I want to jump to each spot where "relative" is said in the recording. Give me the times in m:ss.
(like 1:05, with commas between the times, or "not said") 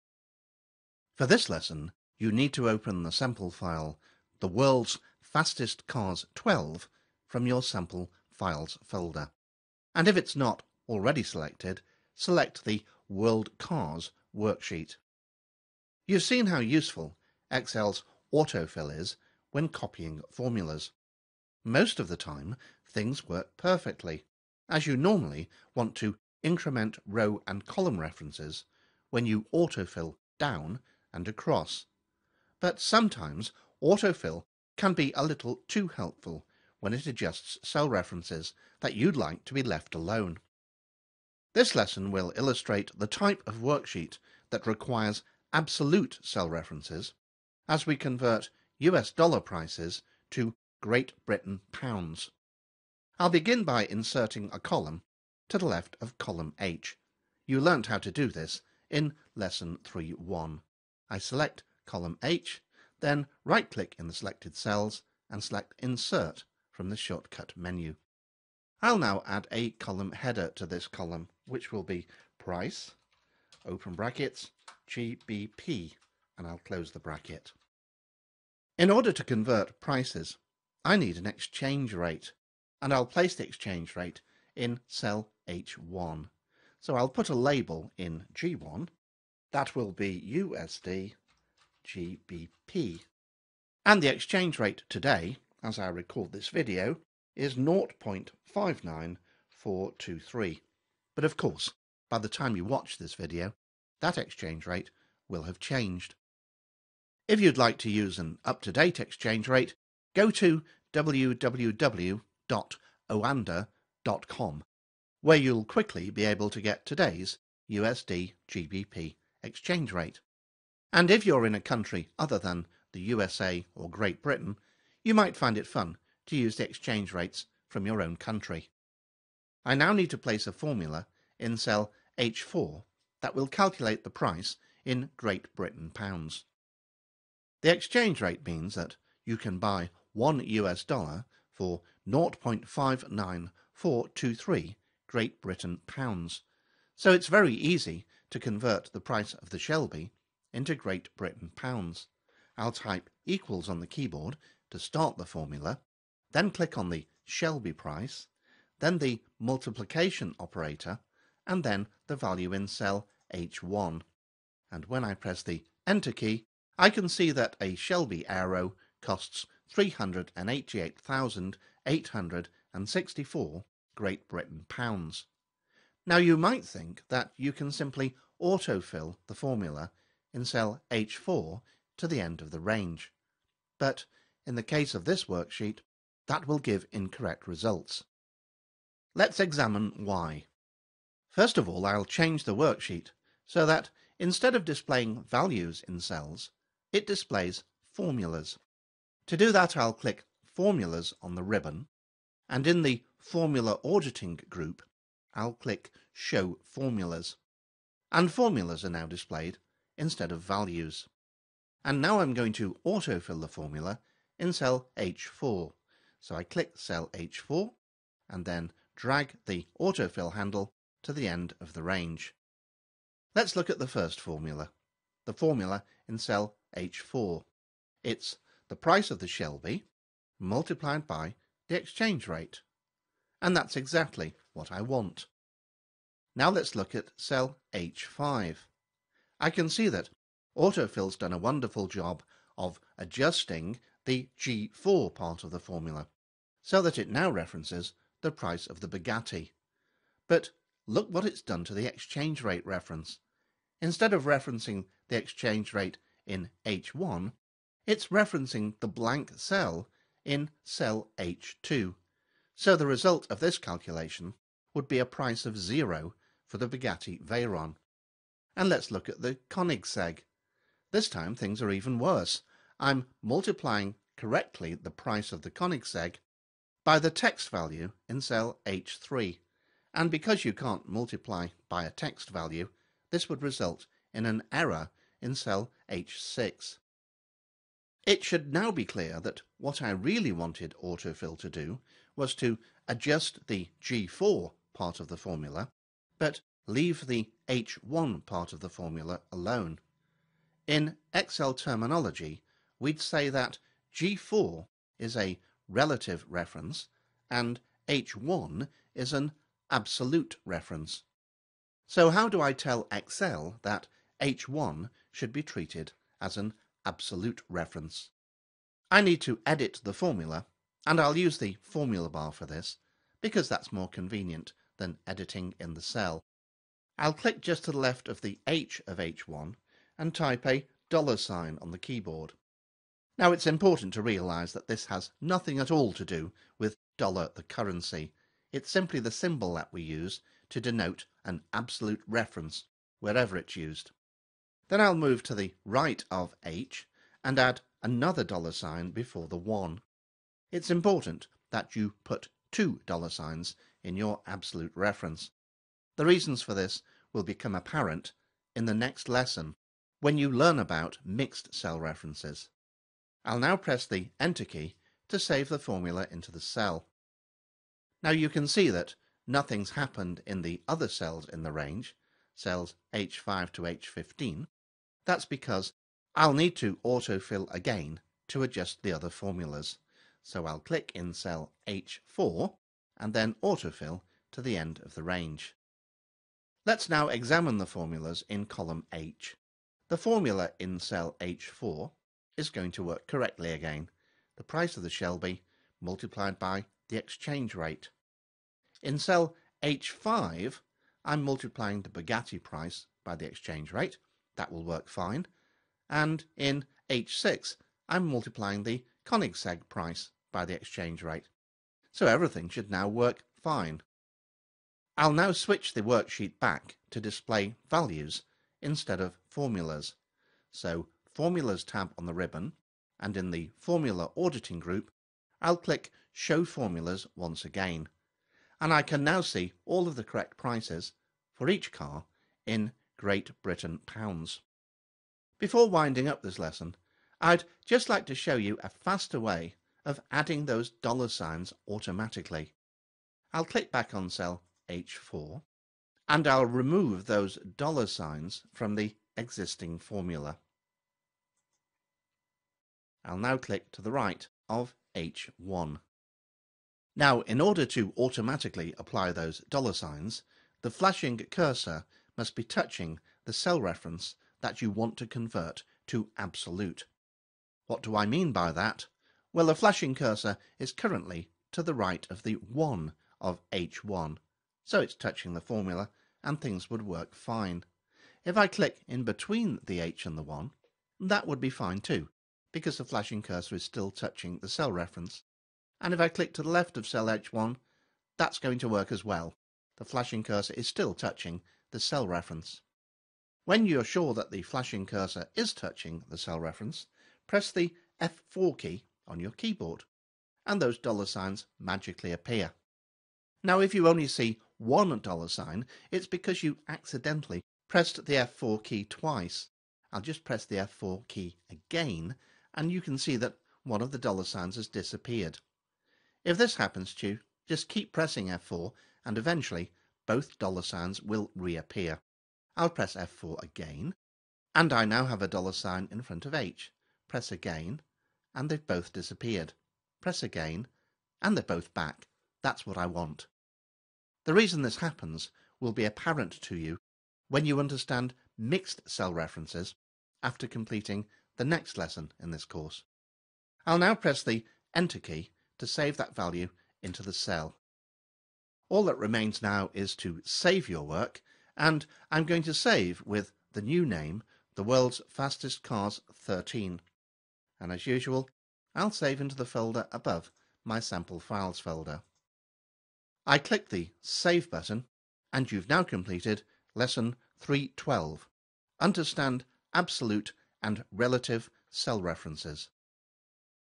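5:05, 9:30.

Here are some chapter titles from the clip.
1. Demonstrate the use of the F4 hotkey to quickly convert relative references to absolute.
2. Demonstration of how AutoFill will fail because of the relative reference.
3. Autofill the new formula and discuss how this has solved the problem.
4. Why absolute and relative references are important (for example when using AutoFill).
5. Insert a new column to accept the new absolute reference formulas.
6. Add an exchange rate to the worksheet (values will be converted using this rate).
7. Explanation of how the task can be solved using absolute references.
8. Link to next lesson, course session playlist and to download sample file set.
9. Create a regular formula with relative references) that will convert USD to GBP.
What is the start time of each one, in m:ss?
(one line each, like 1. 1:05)
1. 7:15
2. 2:55
3. 6:07
4. 0:15
5. 0:52
6. 1:18
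7. 4:48
8. 9:24
9. 2:10.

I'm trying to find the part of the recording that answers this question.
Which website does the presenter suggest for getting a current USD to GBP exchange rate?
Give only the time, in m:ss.
1:50.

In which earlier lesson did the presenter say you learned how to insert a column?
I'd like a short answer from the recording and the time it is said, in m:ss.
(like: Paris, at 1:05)
Lesson 3.1, at 0:59.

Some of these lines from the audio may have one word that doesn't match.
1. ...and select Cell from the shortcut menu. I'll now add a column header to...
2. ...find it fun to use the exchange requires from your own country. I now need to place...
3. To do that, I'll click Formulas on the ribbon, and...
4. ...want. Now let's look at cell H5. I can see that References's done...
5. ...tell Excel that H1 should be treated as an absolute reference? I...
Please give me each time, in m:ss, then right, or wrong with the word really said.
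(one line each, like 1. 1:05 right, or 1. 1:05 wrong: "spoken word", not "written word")
1. 1:05 wrong: "Insert", not "Cell"
2. 2:05 wrong: "rates", not "requires"
3. 3:19 right
4. 3:54 wrong: "Autofill", not "References"
5. 5:12 right.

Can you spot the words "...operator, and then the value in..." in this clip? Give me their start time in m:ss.
2:40.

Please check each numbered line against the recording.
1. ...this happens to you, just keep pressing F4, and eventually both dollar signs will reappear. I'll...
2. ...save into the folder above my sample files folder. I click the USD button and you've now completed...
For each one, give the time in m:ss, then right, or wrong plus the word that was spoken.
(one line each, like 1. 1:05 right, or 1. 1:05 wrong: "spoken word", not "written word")
1. 8:36 right
2. 9:18 wrong: "Save", not "USD".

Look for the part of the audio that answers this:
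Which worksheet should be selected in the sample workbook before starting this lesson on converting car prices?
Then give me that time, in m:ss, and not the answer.
0:13.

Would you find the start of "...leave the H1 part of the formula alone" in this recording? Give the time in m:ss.
4:56.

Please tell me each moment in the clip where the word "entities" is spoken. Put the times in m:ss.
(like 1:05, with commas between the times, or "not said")
not said.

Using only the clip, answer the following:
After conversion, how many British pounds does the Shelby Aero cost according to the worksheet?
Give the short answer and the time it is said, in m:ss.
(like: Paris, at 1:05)
388,864, at 2:49.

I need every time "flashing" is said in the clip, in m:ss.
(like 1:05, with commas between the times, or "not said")
7:40, 7:49, 8:02, 8:09, 8:14.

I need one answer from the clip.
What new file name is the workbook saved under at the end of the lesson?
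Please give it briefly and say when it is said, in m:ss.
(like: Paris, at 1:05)
the world's fastest cars 13, at 9:14.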